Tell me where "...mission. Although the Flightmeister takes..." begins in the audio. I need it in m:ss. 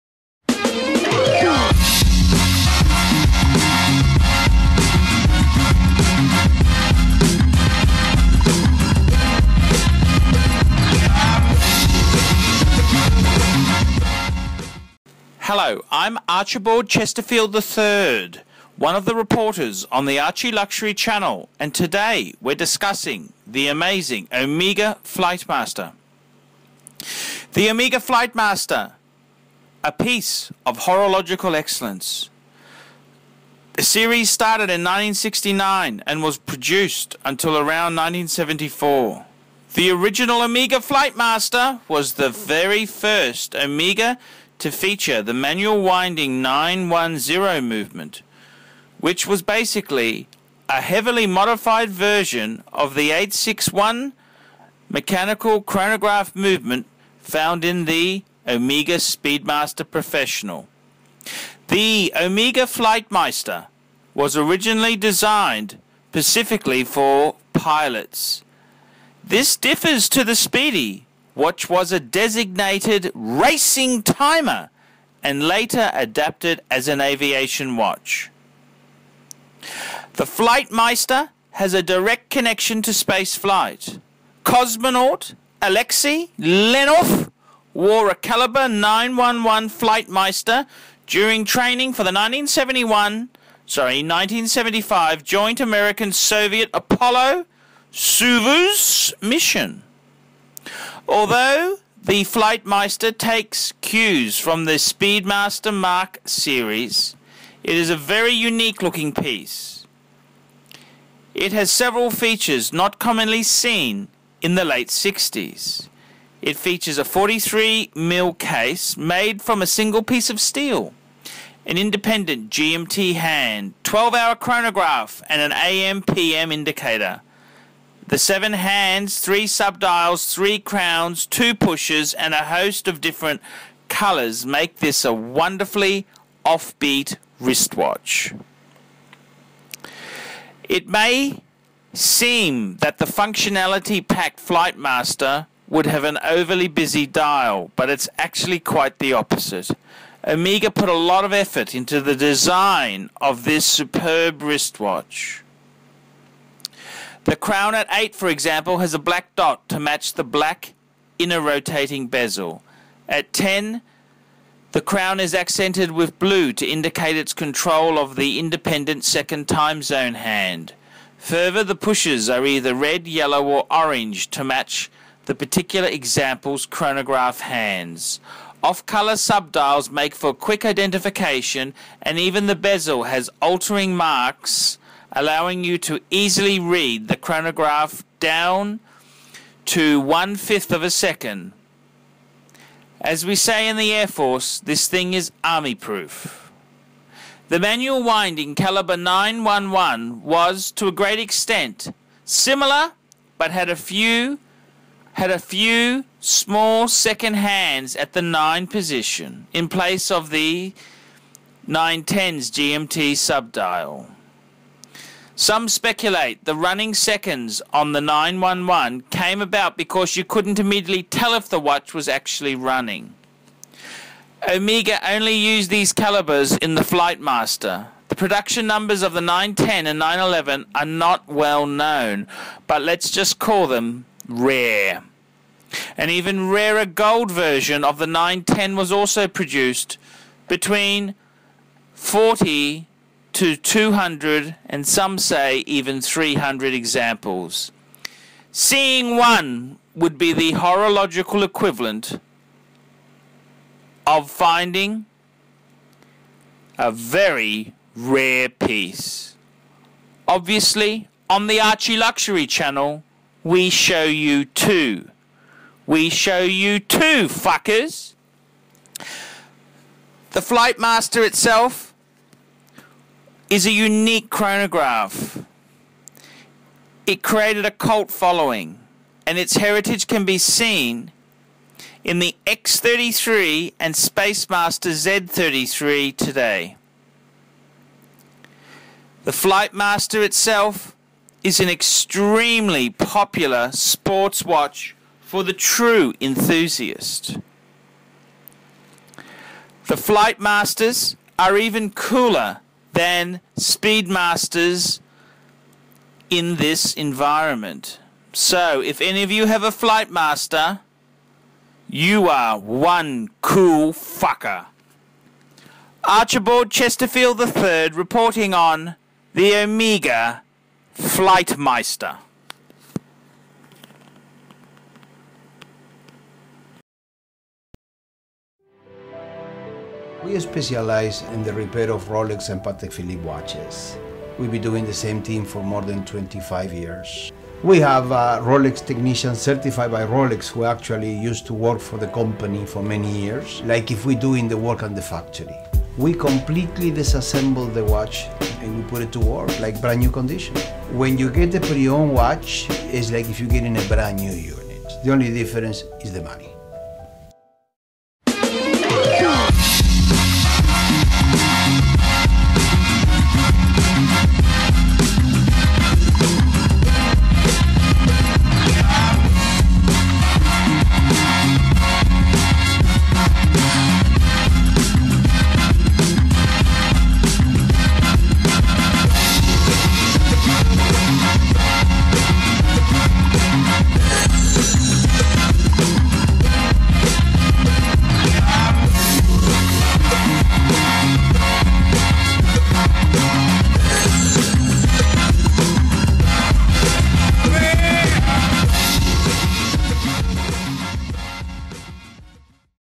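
1:39.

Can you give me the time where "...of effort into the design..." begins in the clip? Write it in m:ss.
2:31.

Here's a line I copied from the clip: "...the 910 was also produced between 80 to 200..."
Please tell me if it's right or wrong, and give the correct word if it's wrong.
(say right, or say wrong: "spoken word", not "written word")
wrong: "40", not "80".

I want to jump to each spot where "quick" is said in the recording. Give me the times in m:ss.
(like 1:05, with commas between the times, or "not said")
3:00.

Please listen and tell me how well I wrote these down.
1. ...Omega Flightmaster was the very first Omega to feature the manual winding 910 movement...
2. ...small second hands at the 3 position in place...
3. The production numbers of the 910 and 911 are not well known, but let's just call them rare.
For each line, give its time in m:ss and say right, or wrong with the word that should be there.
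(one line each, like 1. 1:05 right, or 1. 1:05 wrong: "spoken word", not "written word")
1. 0:40 right
2. 3:26 wrong: "9", not "3"
3. 3:48 right.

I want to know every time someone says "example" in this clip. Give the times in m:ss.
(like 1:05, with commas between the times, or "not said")
2:38, 2:55, 4:06.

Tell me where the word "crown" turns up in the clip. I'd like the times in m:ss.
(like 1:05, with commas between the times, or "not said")
2:10, 2:37, 2:44.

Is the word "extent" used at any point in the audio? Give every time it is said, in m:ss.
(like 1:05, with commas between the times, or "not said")
3:21.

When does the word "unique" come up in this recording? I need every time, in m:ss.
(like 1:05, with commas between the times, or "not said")
1:48, 4:33.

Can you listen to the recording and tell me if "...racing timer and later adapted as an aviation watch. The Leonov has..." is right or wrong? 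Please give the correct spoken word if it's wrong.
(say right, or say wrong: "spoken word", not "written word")
wrong: "Flightmeister", not "Leonov".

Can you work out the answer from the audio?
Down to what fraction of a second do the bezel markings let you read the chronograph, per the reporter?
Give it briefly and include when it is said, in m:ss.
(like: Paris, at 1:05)
One fifth, at 3:09.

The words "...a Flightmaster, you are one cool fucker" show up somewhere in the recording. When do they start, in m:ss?
5:09.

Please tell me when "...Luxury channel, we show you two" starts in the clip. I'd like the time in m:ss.
4:21.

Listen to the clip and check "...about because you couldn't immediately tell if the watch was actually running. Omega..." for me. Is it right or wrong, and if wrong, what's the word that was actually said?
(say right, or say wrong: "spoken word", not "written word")
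right.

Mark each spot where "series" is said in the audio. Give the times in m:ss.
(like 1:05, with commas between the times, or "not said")
0:33, 1:46.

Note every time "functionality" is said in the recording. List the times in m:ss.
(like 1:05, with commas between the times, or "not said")
2:23.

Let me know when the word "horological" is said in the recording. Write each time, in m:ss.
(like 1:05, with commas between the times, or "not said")
0:30, 4:10.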